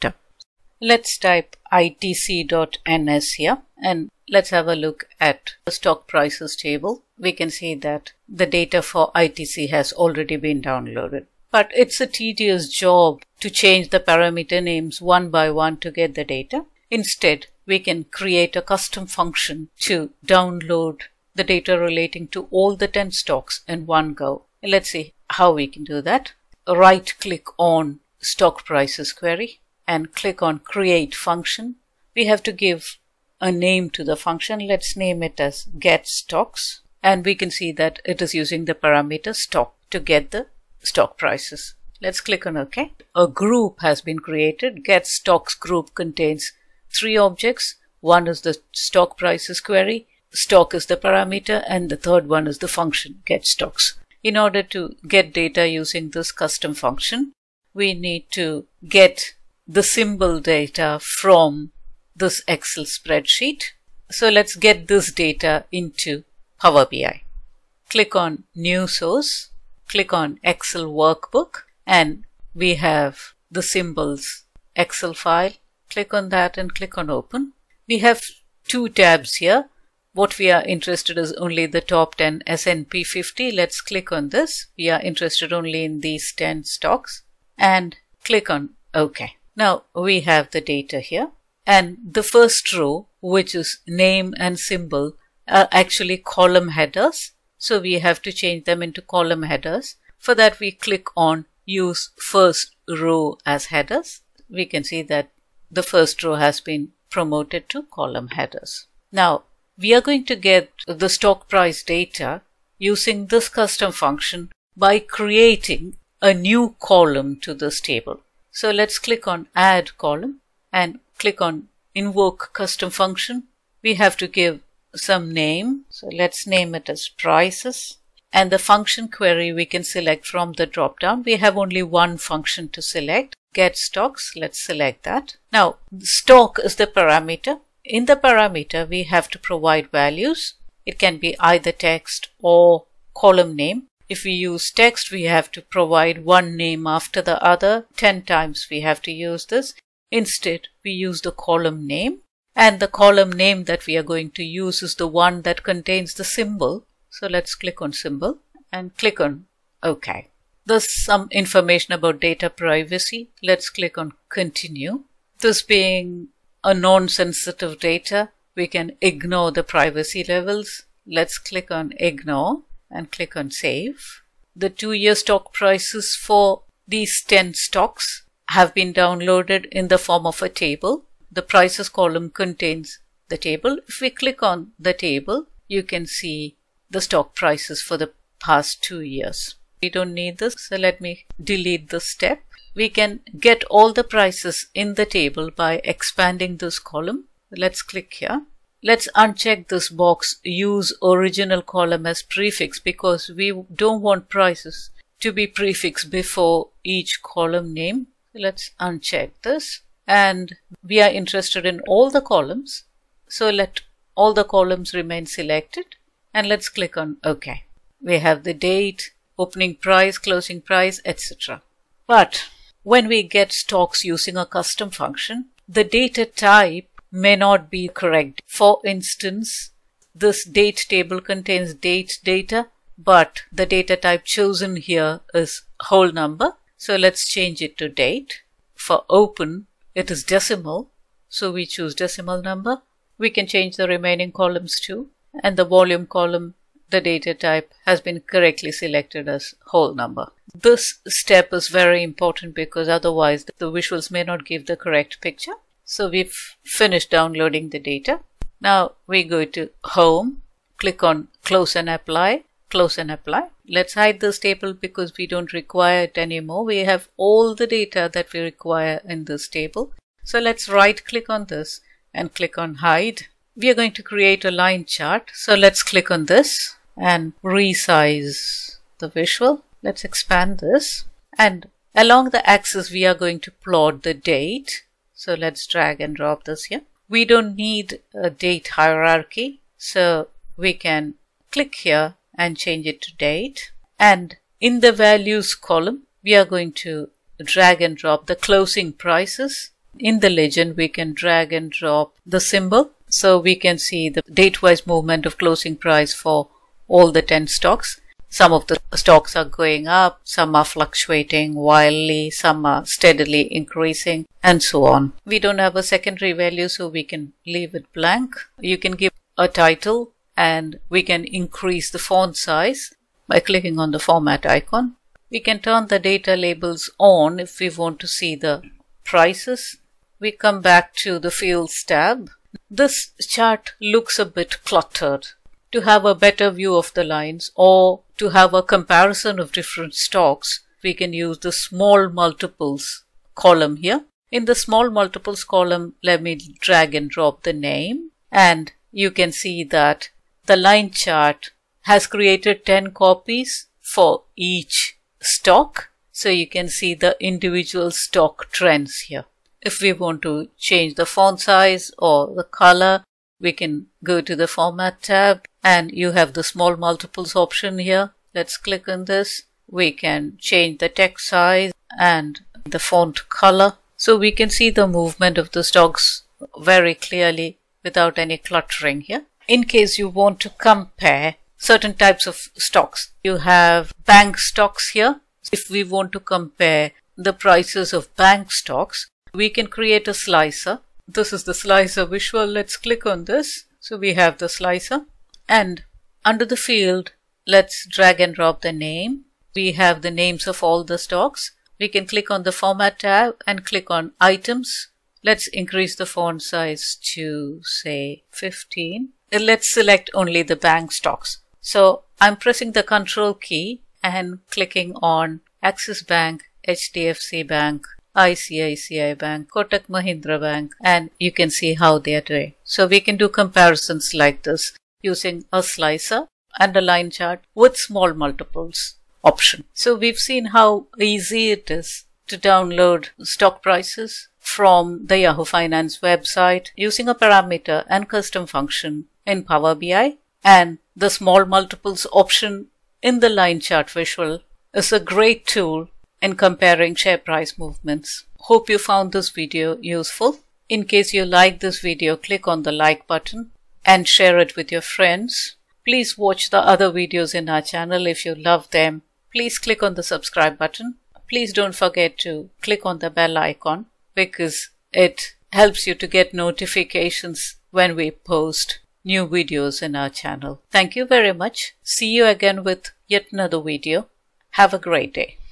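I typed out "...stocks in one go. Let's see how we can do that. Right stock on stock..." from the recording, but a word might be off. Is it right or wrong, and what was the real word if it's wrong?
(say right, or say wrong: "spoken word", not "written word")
wrong: "click", not "stock".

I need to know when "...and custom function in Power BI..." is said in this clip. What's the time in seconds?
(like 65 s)
437 s.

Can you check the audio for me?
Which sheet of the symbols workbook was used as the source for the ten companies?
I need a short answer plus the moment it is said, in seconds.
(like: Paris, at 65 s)
top 10 S&P 50, at 81 s.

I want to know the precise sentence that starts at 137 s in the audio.
In the parameter we have to provide values.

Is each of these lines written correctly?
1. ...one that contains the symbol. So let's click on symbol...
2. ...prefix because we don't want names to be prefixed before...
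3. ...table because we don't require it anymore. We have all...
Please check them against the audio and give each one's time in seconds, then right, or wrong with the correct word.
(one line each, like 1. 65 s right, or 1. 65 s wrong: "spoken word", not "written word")
1. 155 s right
2. 202 s wrong: "prices", not "names"
3. 264 s right.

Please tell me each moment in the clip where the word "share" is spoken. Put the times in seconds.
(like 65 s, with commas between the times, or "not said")
446 s, 454 s.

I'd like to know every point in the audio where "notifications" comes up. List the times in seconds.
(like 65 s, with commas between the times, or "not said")
466 s.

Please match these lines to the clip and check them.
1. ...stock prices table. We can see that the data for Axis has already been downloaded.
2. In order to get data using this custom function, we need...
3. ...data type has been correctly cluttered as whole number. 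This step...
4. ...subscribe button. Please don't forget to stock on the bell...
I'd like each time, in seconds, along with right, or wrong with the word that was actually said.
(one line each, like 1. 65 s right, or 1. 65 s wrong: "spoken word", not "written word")
1. 5 s wrong: "ITC", not "Axis"
2. 54 s right
3. 247 s wrong: "selected", not "cluttered"
4. 460 s wrong: "click", not "stock".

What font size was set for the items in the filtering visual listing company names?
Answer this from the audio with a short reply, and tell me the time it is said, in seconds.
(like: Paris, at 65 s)
15, at 408 s.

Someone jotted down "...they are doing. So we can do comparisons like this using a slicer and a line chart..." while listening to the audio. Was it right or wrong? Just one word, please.
right.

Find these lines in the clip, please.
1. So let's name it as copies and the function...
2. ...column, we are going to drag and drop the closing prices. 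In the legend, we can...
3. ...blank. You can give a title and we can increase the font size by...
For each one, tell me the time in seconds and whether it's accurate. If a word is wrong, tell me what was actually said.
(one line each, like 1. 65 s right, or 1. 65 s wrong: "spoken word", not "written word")
1. 125 s wrong: "prices", not "copies"
2. 295 s right
3. 317 s right.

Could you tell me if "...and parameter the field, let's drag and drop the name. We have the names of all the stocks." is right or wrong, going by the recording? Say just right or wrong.
wrong.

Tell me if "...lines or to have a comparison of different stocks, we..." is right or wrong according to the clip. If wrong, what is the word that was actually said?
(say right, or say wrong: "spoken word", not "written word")
right.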